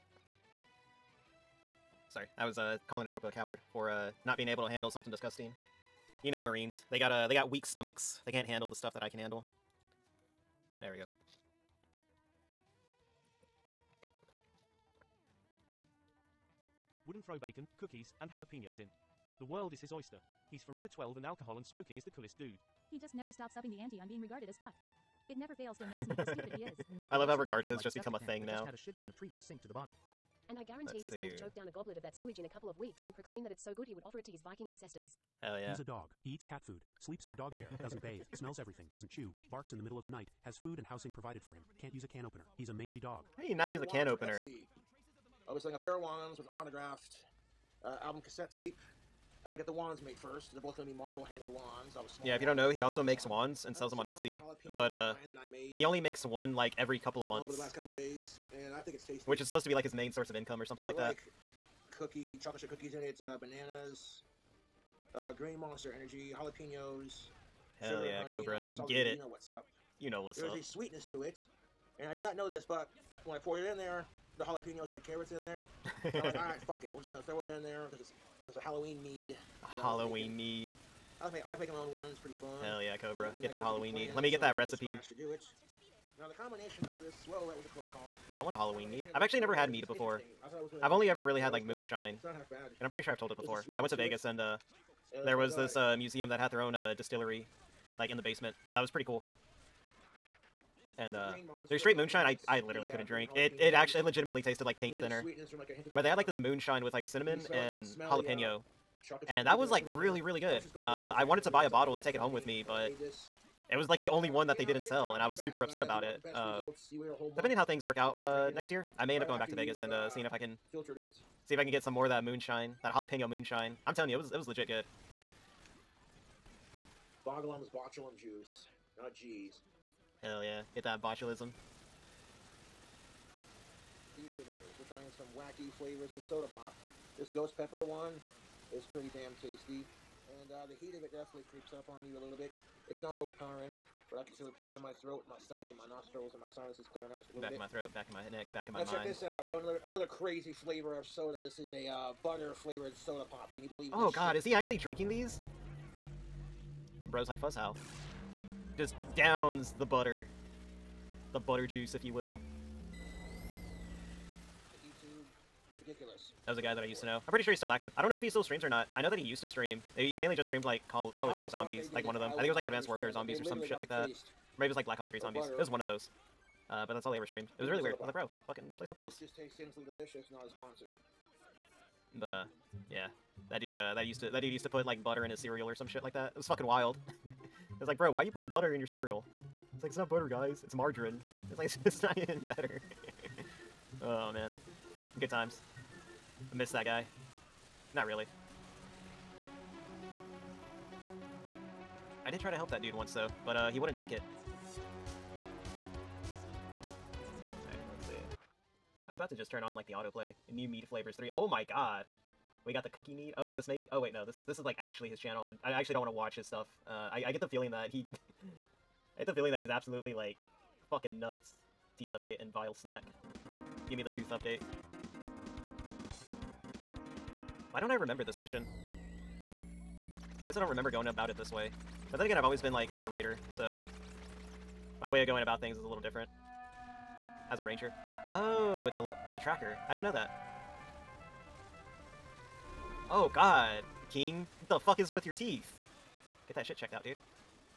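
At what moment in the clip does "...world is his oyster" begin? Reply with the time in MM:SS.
00:19.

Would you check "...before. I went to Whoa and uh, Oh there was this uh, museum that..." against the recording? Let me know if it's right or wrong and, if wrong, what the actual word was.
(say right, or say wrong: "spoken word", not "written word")
wrong: "Vegas", not "Whoa".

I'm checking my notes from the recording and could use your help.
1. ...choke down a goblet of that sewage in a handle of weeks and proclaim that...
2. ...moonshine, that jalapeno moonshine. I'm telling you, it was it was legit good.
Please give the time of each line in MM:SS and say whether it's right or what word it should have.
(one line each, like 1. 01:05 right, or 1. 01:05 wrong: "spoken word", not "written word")
1. 00:31 wrong: "couple", not "handle"
2. 02:02 right.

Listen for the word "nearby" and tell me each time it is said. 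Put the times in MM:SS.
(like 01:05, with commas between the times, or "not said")
not said.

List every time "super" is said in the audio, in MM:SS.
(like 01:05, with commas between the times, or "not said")
01:55.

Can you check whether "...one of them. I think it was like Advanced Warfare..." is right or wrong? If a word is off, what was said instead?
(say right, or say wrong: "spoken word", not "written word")
right.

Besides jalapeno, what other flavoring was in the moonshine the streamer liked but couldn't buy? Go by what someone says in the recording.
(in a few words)
cinnamon.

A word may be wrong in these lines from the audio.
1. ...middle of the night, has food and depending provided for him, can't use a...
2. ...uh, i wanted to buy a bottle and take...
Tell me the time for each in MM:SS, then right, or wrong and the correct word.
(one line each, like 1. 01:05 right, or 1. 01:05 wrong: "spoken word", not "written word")
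1. 00:39 wrong: "housing", not "depending"
2. 01:50 right.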